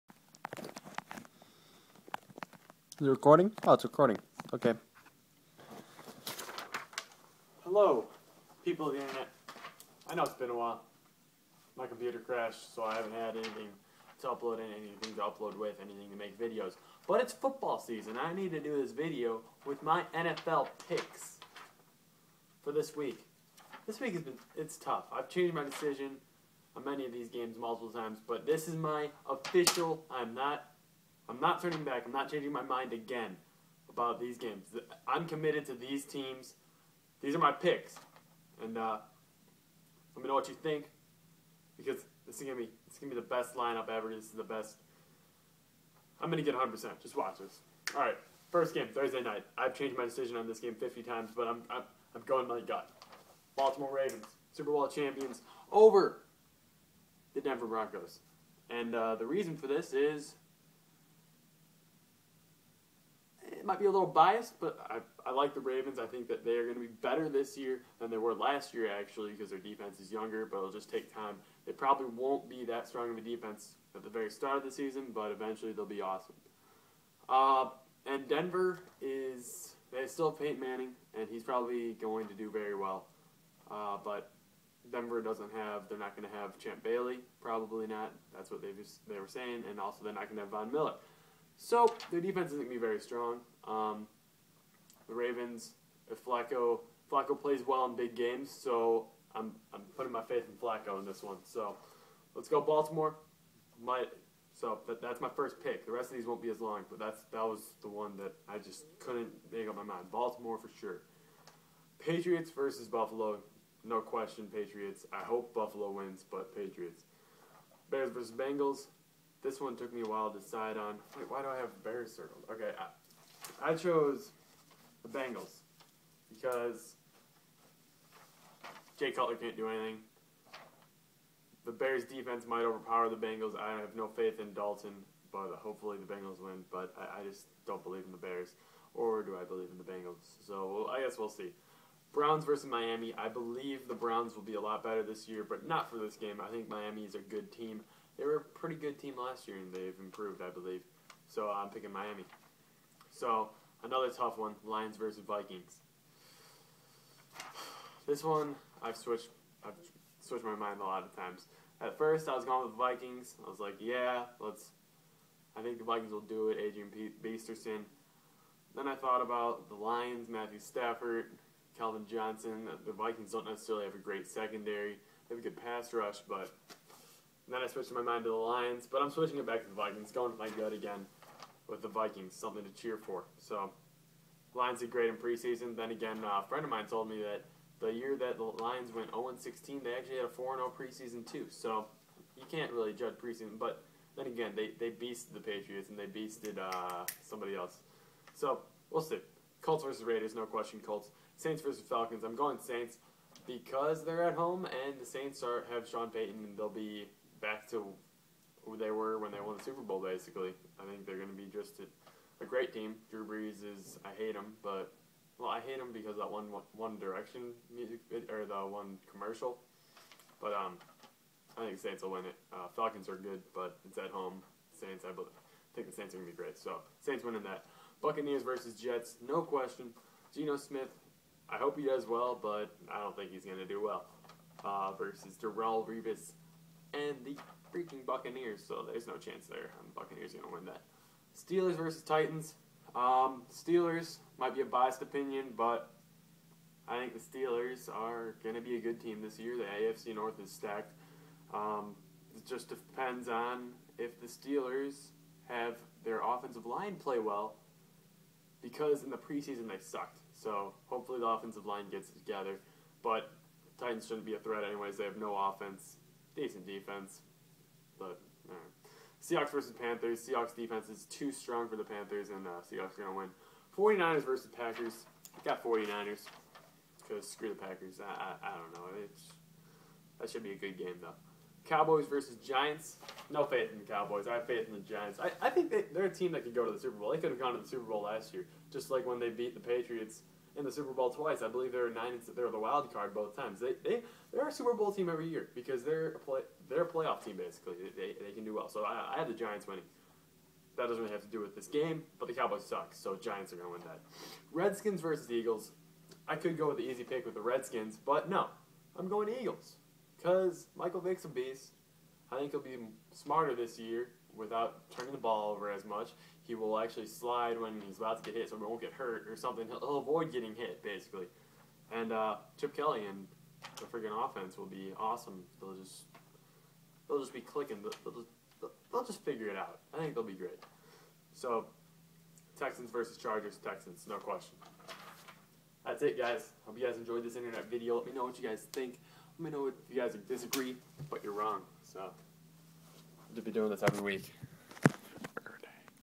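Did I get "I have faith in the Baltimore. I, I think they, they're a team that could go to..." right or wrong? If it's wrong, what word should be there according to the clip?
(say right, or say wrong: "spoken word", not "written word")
wrong: "Giants", not "Baltimore".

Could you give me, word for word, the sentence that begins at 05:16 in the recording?
He will actually slide when he's about to get hit, so he won't get hurt or something.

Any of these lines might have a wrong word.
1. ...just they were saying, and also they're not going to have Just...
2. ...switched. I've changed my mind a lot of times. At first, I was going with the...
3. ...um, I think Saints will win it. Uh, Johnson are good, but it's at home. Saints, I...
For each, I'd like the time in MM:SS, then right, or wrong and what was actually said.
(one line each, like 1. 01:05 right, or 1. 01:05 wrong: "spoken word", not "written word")
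1. 01:28 wrong: "Von", not "Just"
2. 02:38 wrong: "switched", not "changed"
3. 03:40 wrong: "Falcons", not "Johnson".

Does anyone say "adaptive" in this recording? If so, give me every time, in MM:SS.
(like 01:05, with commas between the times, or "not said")
not said.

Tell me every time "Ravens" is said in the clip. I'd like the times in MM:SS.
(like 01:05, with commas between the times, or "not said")
00:53, 01:05, 01:35.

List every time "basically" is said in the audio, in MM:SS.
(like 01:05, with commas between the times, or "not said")
03:29, 04:57, 05:20.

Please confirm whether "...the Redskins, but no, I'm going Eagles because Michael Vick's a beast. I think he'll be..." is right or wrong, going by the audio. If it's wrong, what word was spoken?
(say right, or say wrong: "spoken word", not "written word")
right.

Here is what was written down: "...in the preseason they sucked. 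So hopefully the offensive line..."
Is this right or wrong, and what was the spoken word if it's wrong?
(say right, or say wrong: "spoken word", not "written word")
right.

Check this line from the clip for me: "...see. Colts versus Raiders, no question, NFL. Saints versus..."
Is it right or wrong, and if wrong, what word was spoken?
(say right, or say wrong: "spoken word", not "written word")
wrong: "Colts", not "NFL".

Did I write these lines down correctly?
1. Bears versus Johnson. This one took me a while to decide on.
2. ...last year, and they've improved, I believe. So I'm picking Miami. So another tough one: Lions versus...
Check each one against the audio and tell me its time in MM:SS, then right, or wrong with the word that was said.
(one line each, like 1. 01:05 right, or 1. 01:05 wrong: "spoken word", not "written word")
1. 01:57 wrong: "Bengals", not "Johnson"
2. 02:29 right.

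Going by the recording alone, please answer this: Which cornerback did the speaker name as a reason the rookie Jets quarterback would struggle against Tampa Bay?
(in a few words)
Darrelle Revis.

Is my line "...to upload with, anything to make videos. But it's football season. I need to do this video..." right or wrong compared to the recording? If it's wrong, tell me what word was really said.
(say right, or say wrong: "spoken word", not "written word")
right.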